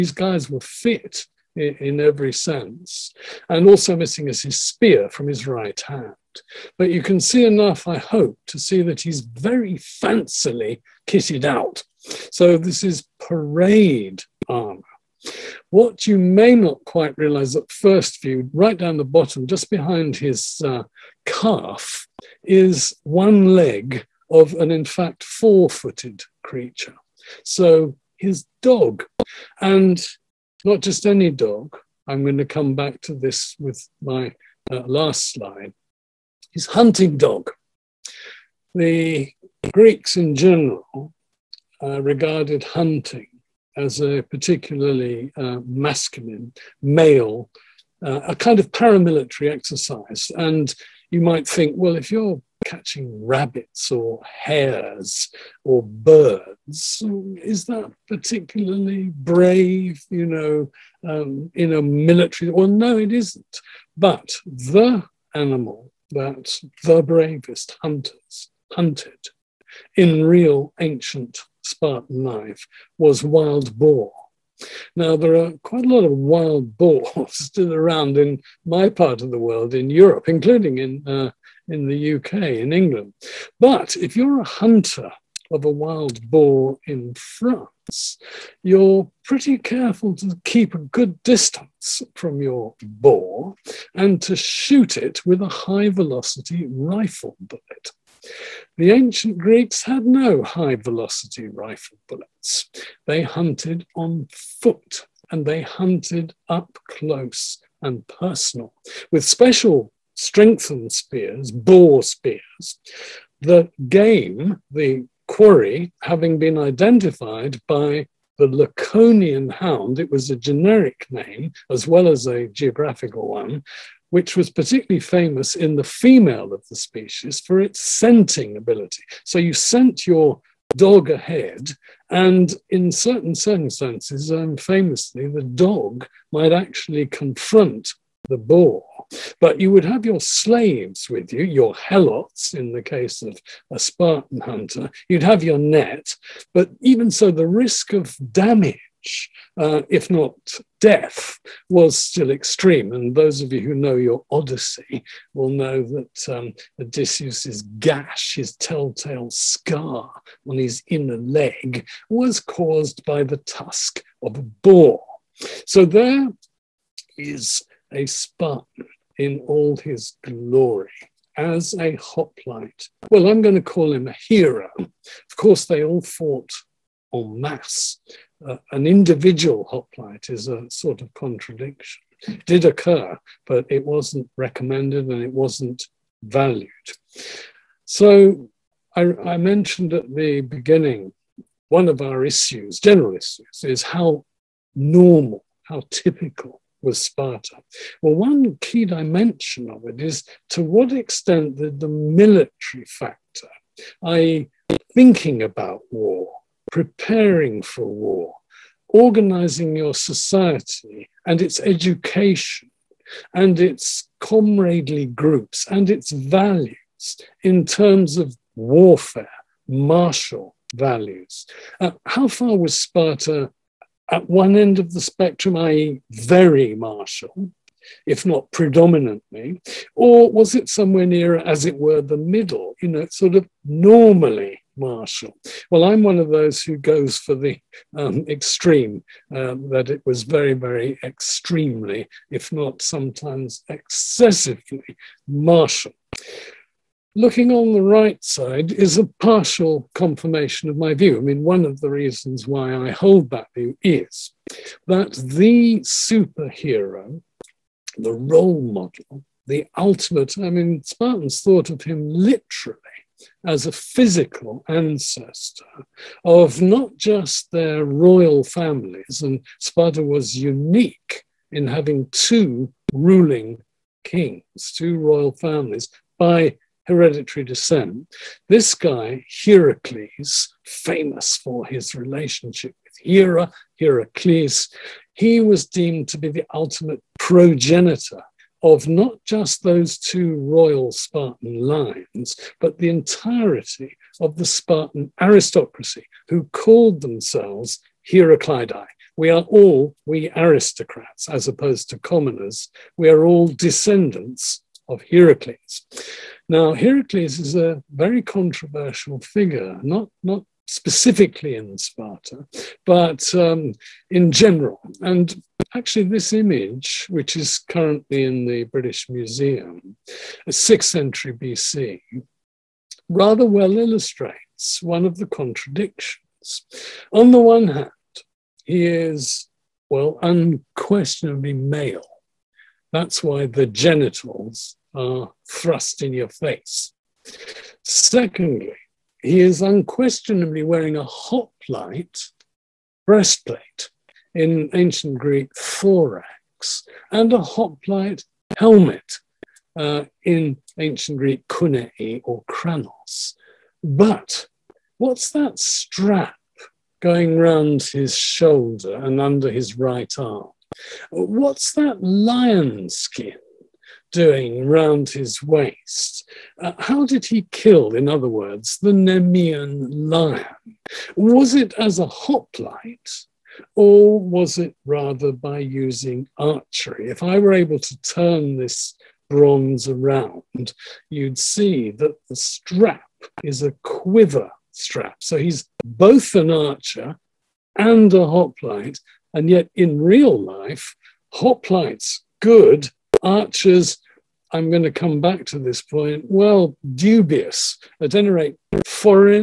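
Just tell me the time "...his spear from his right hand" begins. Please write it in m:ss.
0:04.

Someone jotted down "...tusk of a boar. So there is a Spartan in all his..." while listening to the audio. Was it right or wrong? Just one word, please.
right.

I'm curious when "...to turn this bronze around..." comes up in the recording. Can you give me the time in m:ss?
6:17.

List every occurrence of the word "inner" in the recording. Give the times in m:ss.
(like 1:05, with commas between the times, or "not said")
2:40.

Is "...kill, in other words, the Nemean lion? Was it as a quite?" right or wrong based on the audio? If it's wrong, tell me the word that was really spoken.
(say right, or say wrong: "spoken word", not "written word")
wrong: "hoplite", not "quite".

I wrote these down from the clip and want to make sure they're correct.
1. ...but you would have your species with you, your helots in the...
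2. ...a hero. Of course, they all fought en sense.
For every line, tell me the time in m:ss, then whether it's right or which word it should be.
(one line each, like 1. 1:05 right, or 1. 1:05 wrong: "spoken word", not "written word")
1. 2:19 wrong: "slaves", not "species"
2. 2:54 wrong: "masse", not "sense".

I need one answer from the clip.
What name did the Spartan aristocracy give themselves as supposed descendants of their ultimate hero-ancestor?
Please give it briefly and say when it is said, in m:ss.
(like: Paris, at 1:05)
Heraclidae, at 4:58.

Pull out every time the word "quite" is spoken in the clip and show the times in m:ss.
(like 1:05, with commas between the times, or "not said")
0:16, 1:15.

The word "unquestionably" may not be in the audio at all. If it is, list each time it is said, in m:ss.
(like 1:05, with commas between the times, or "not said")
5:30, 5:39.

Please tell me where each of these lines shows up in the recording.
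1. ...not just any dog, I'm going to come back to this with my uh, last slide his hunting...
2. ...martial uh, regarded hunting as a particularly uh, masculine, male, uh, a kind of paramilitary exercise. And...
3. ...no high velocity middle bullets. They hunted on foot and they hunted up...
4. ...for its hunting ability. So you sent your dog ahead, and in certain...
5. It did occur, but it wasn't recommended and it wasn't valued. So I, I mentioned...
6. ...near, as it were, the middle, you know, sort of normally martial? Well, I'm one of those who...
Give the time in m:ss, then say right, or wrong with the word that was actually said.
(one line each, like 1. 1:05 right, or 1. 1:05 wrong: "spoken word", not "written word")
1. 0:30 right
2. 0:40 wrong: "general", not "martial"
3. 1:40 wrong: "rifle", not "middle"
4. 2:07 wrong: "scenting", not "hunting"
5. 3:02 right
6. 3:51 right.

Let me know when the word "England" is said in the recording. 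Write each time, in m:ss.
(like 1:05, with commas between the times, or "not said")
1:22.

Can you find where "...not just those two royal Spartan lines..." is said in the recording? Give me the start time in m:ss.
4:48.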